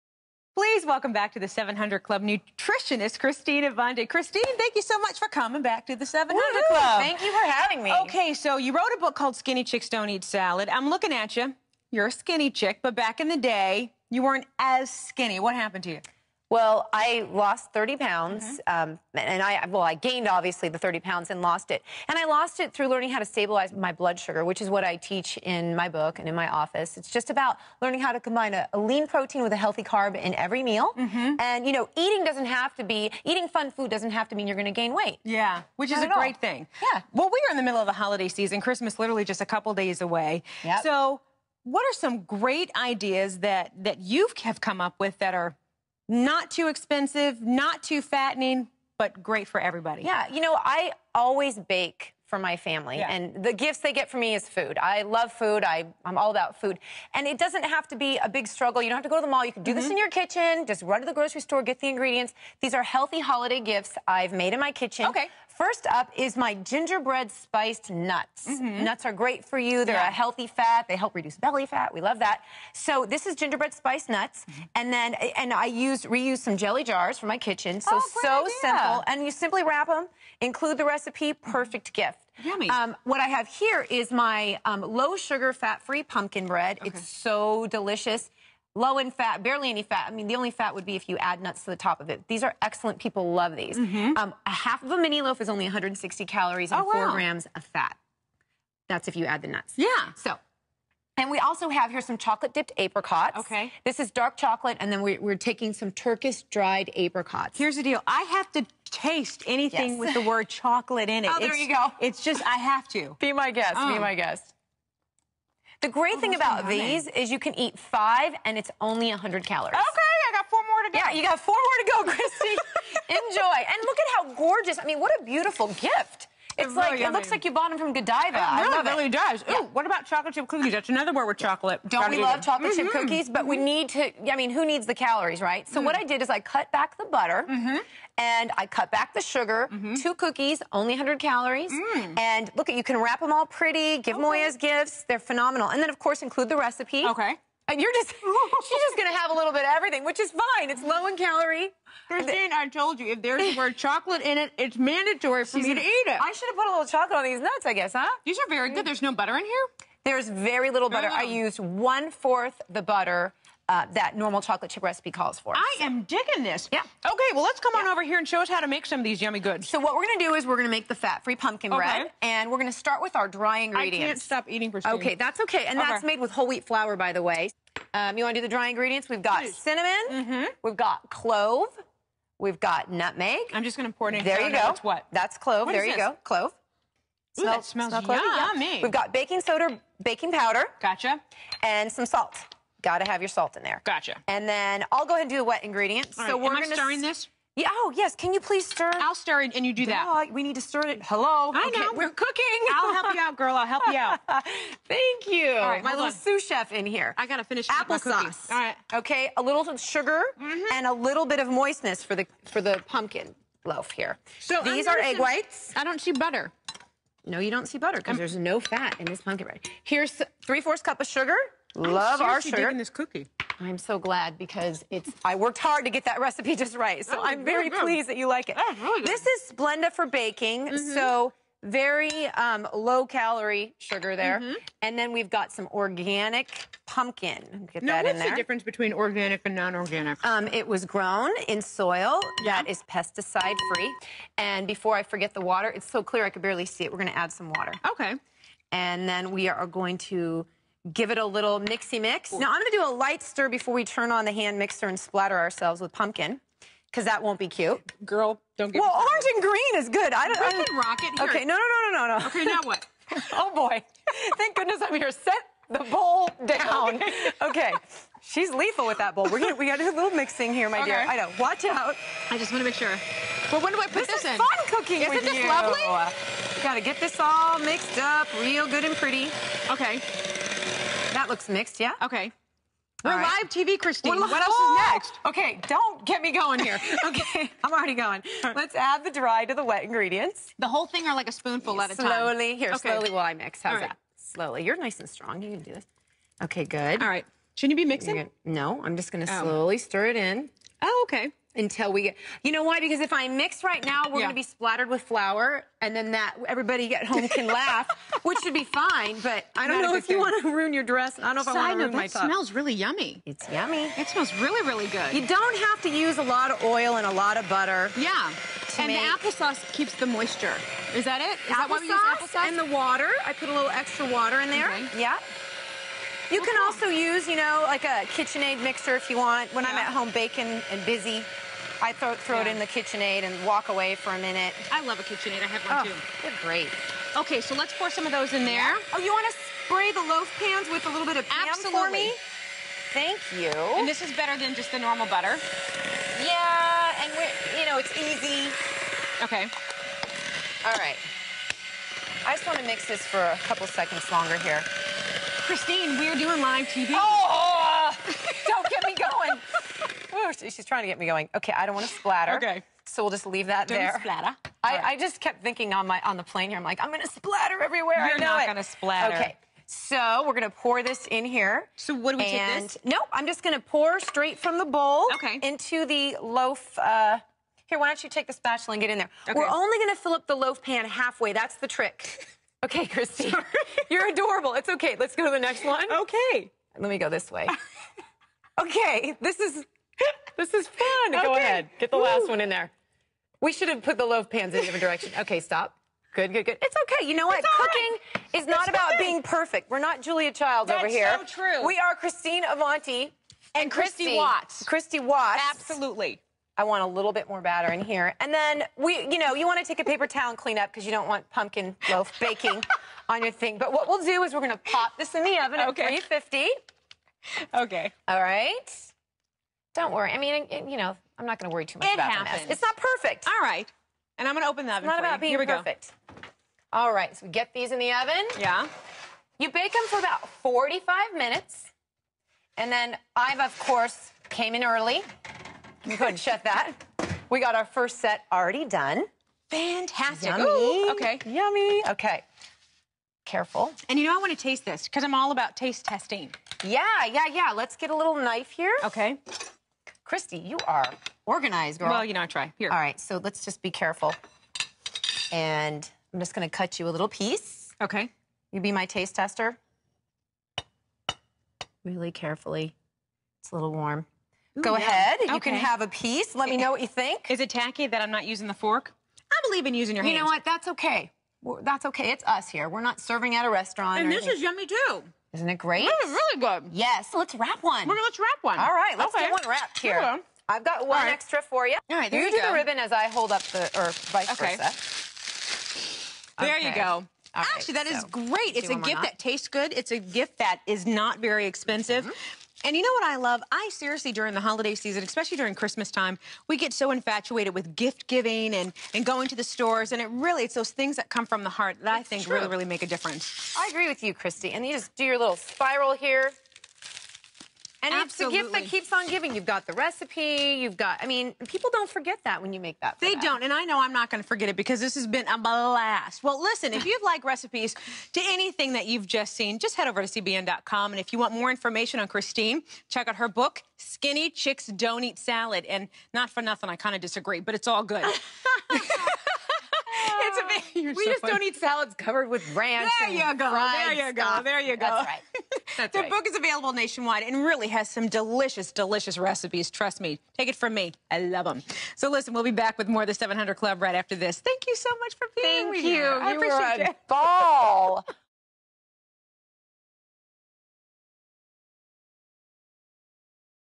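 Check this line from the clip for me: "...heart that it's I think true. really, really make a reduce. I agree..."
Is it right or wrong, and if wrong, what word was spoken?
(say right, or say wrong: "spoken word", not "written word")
wrong: "difference", not "reduce".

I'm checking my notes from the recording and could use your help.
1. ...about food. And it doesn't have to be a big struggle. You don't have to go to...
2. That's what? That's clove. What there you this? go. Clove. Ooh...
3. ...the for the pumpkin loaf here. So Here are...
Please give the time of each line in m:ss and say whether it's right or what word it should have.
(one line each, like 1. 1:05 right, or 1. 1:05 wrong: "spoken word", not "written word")
1. 0:56 right
2. 3:04 right
3. 3:32 wrong: "These", not "Here".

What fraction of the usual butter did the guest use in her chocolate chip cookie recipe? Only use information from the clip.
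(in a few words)
One fourth.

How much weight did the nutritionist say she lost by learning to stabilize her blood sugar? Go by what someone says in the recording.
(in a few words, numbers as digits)
30 pounds.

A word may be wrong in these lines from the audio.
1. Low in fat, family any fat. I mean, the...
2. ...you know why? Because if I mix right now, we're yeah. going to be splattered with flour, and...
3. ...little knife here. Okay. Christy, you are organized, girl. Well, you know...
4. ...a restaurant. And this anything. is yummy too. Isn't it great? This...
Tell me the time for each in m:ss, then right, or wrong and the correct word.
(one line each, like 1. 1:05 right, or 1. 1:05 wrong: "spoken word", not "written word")
1. 1:28 wrong: "barely", not "family"
2. 5:02 right
3. 7:27 right
4. 7:53 right.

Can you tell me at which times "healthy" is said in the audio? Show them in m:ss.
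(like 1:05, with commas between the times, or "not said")
0:29, 1:02, 1:10.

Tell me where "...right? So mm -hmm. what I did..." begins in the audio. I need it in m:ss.
2:15.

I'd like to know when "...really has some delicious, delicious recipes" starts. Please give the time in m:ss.
8:57.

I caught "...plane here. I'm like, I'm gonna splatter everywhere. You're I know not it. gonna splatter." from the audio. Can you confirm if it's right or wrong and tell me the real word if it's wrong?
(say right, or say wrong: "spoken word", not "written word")
right.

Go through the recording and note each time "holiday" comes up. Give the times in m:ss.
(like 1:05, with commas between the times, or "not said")
0:37, 1:03, 8:14.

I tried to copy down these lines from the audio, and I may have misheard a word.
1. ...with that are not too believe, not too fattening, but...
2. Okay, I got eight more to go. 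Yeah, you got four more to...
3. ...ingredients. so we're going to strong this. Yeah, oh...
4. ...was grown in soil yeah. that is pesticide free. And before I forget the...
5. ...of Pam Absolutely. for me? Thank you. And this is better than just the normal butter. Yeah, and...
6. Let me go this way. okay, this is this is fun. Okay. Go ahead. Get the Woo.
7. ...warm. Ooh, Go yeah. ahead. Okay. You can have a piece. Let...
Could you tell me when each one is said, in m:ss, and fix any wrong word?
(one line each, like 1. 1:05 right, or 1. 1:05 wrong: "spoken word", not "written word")
1. 0:44 wrong: "expensive", not "believe"
2. 1:59 wrong: "four", not "eight"
3. 3:15 wrong: "stirring", not "strong"
4. 4:00 right
5. 5:41 right
6. 6:26 right
7. 7:43 right.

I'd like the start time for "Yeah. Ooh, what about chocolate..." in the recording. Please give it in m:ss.
2:09.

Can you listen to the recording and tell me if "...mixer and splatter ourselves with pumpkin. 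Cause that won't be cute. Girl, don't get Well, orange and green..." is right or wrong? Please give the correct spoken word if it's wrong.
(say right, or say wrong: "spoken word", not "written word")
right.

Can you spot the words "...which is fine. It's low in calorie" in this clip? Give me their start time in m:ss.
2:30.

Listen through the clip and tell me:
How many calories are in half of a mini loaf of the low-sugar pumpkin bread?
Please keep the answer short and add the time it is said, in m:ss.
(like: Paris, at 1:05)
160, at 1:35.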